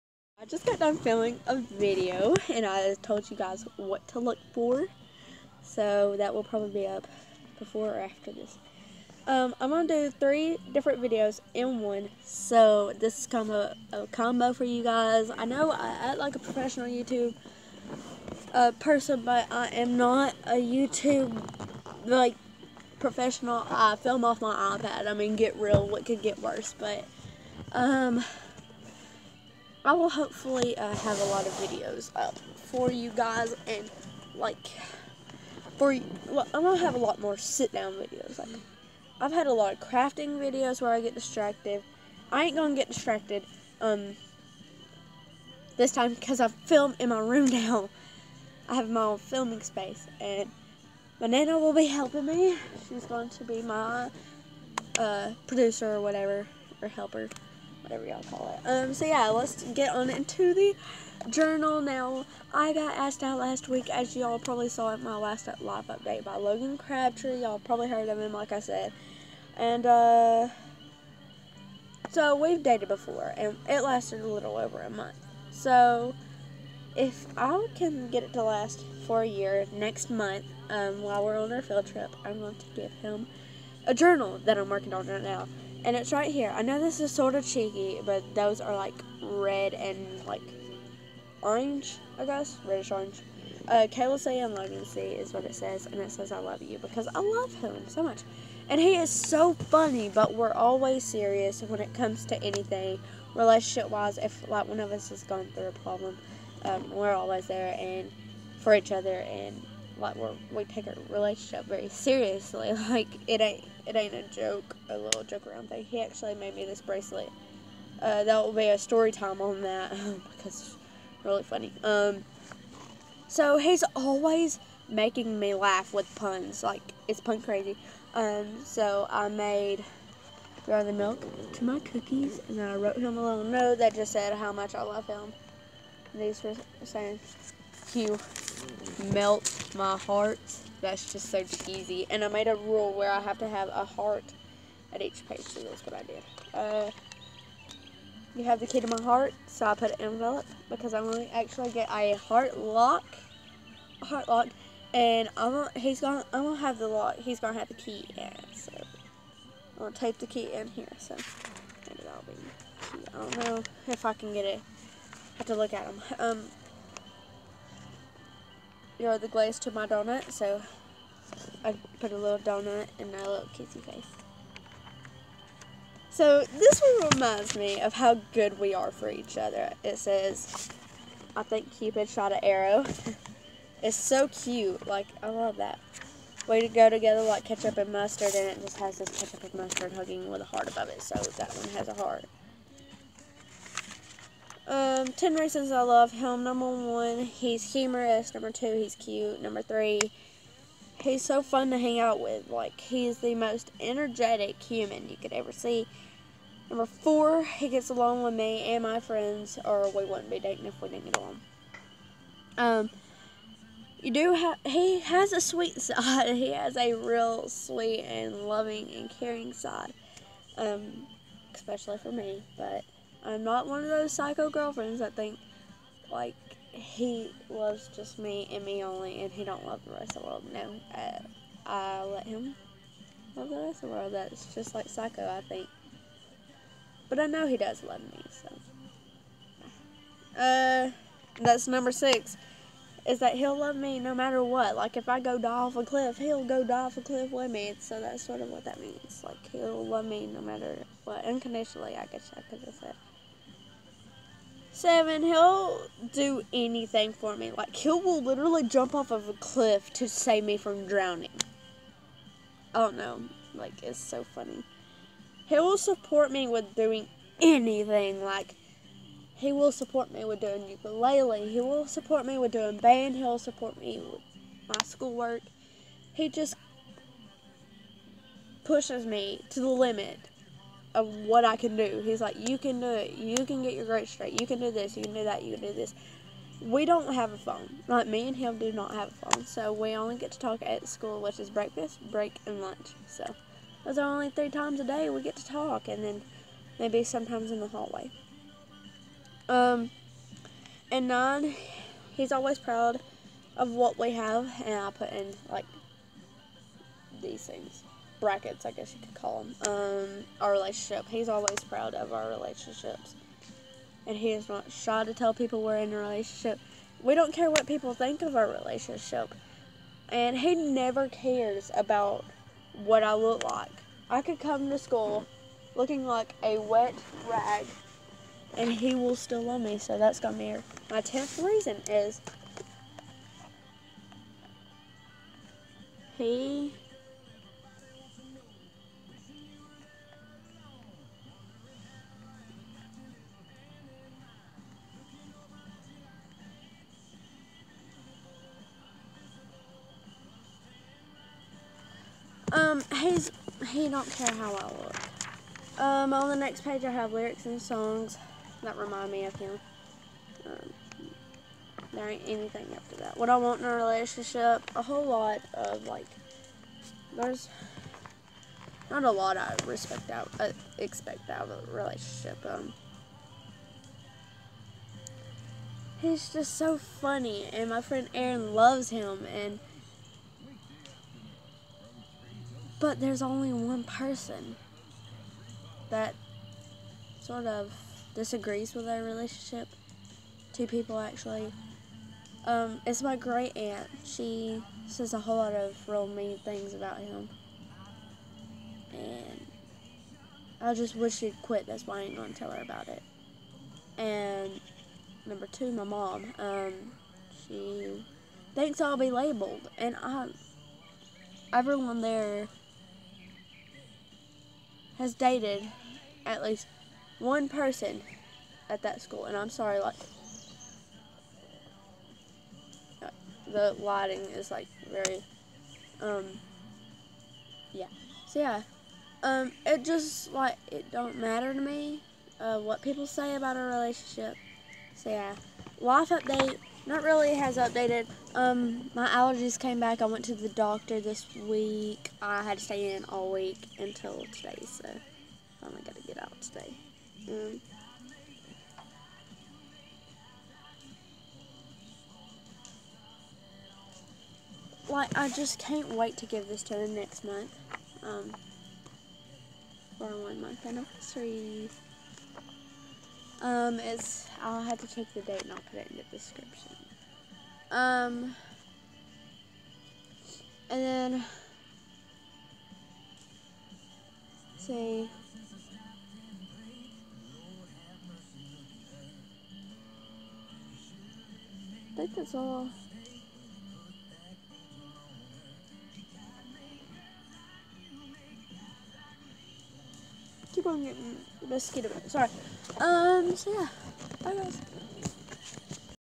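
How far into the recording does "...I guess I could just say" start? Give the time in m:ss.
4:11.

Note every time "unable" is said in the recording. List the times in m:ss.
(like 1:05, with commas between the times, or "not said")
not said.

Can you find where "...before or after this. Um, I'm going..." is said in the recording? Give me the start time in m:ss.
0:07.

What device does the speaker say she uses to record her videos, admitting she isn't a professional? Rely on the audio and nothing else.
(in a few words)
iPad.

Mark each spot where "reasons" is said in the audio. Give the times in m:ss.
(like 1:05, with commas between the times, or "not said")
3:15, 5:31.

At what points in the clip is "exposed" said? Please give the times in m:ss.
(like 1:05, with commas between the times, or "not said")
not said.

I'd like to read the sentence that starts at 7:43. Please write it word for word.
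Um, it's, I'll have to check the date and I'll put it in the description.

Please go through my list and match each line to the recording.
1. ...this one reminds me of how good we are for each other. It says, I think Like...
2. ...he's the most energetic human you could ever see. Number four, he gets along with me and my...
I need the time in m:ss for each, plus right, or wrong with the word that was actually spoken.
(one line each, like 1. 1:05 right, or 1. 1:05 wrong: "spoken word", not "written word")
1. 2:56 wrong: "Cupid", not "Like"
2. 3:22 right.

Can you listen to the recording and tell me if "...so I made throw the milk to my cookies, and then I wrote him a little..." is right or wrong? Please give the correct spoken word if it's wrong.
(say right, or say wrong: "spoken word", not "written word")
right.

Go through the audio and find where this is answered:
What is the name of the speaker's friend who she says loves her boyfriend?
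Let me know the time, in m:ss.
6:18.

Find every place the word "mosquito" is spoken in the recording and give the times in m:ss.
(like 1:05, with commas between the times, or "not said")
8:11.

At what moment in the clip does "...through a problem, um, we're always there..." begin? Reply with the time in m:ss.
1:45.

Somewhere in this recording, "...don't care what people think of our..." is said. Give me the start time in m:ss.
5:17.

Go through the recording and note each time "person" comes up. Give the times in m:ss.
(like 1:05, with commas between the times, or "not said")
0:18, 6:23, 6:57.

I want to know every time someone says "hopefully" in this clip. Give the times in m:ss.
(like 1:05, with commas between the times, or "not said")
0:30.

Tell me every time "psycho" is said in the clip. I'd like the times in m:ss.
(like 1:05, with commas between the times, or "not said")
3:44, 3:54.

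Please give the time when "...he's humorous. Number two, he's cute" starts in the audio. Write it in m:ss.
3:17.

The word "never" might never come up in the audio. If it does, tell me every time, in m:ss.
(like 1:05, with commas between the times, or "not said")
5:20.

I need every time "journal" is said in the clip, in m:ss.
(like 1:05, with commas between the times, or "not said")
1:01, 1:23.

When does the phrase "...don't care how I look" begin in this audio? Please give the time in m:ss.
5:53.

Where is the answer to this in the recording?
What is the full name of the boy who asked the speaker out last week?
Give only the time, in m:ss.
1:06.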